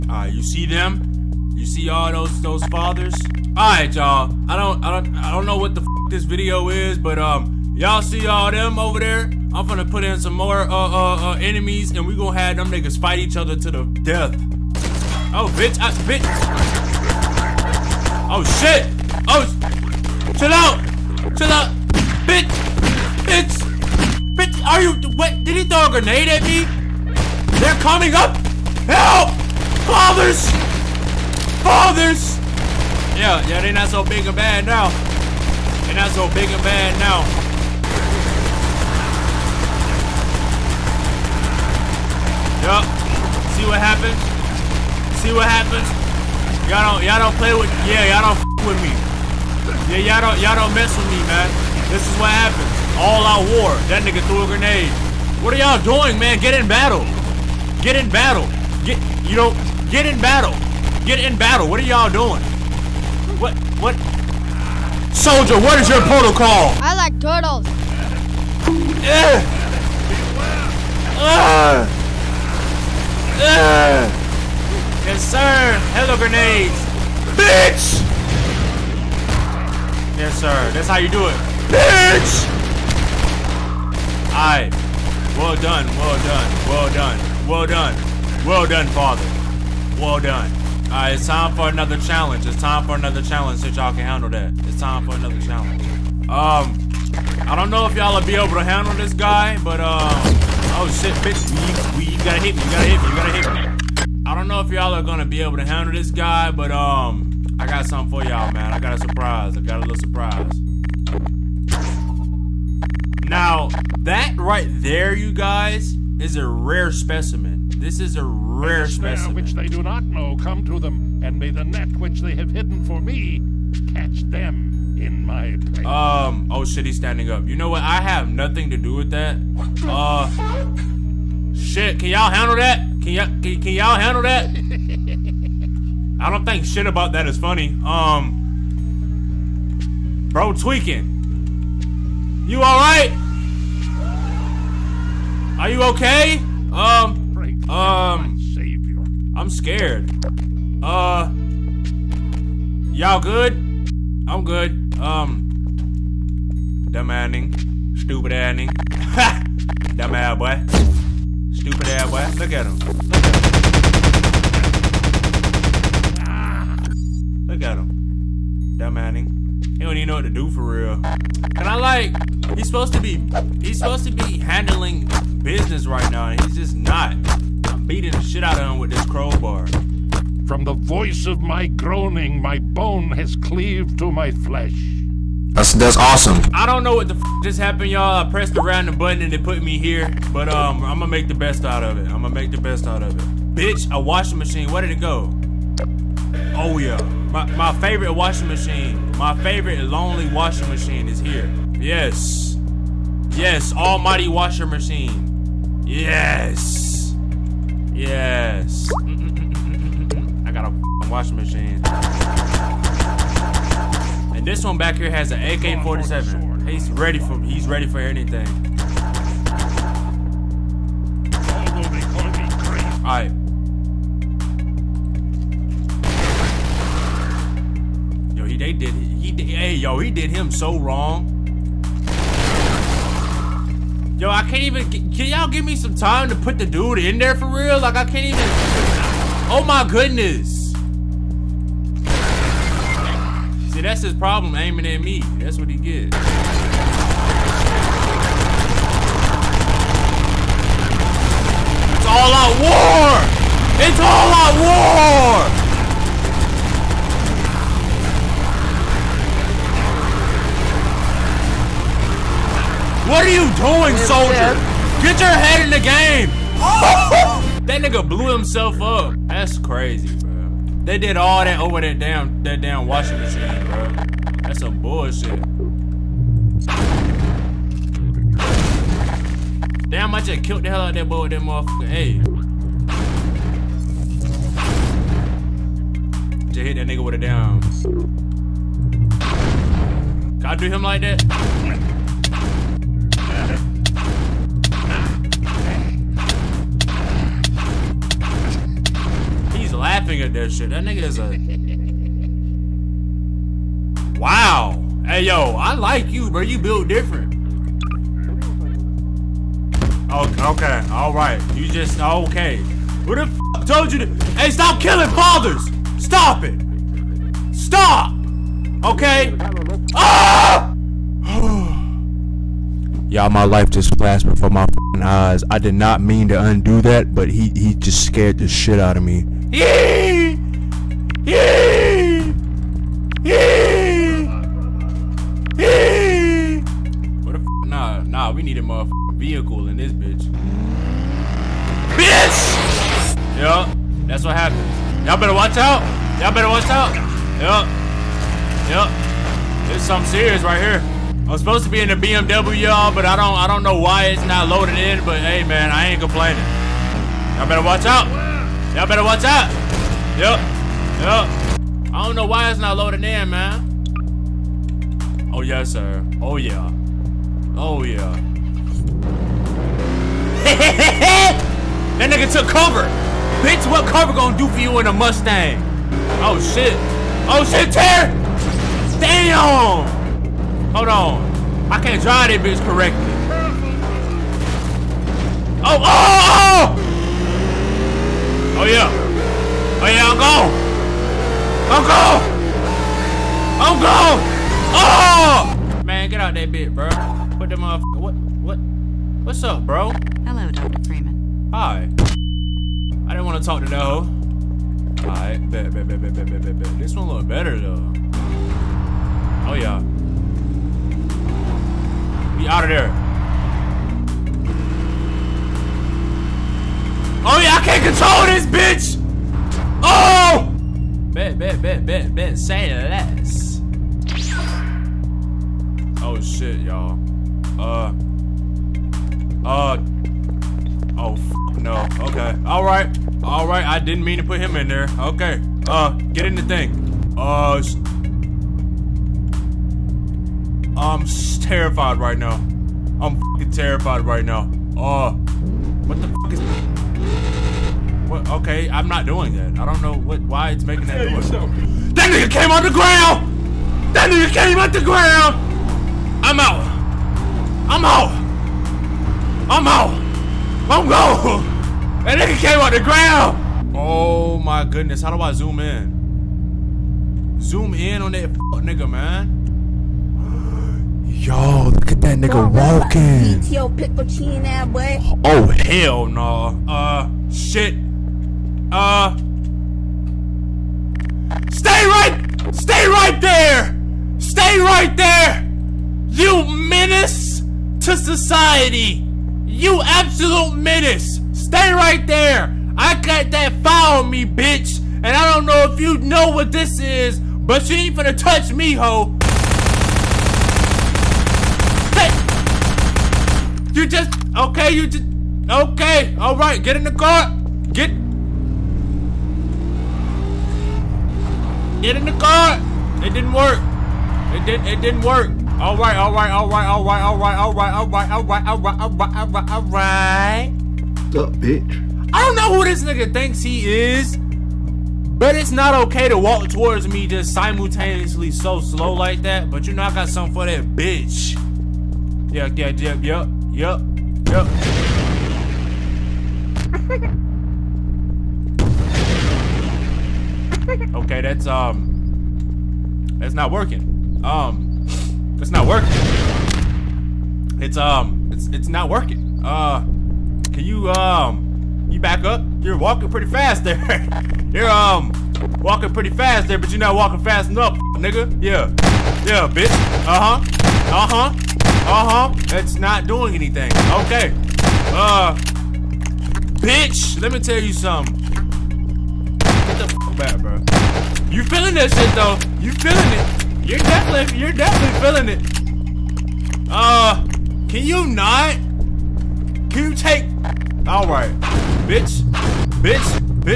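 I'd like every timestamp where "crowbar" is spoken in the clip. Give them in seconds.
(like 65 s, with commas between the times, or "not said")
179 s.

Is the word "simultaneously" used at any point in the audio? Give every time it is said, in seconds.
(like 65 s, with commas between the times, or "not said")
527 s.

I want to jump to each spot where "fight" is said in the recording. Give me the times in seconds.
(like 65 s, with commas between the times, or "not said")
12 s.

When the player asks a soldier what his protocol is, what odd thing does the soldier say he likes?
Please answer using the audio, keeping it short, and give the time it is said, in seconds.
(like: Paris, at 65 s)
Turtles, at 66 s.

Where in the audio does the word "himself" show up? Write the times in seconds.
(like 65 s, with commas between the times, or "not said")
268 s.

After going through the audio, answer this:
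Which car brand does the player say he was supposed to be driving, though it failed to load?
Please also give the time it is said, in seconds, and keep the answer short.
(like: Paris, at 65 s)
BMW, at 351 s.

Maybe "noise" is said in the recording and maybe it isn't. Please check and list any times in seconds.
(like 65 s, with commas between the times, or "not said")
451 s.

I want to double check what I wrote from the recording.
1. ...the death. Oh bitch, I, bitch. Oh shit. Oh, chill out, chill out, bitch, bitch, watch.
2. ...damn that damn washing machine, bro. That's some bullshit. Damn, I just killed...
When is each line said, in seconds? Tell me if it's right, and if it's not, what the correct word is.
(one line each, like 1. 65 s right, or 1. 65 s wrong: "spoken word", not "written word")
1. 13 s wrong: "bitch", not "watch"
2. 271 s right.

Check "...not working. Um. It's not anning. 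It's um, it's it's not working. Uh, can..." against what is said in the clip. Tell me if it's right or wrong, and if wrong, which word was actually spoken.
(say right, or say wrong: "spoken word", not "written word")
wrong: "working", not "anning".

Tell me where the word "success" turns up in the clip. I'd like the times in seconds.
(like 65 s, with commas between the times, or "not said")
not said.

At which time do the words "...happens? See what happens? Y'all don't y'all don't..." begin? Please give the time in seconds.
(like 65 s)
43 s.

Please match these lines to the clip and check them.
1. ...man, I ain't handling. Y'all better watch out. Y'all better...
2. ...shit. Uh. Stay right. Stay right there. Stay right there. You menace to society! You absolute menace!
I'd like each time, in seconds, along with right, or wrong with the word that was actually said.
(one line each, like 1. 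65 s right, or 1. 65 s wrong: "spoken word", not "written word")
1. 355 s wrong: "complaining", not "handling"
2. 477 s right.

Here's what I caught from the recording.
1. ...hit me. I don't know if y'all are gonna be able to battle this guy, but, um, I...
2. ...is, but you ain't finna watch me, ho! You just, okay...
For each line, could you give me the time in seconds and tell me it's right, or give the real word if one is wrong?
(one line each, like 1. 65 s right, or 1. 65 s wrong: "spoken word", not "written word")
1. 103 s wrong: "handle", not "battle"
2. 496 s wrong: "touch", not "watch".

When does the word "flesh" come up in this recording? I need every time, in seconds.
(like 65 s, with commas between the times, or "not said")
184 s.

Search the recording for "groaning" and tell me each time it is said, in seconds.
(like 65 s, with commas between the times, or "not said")
181 s.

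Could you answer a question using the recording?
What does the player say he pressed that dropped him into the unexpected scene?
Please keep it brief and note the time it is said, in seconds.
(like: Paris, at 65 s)
Random button, at 188 s.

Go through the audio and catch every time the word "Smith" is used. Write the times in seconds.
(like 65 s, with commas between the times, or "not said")
not said.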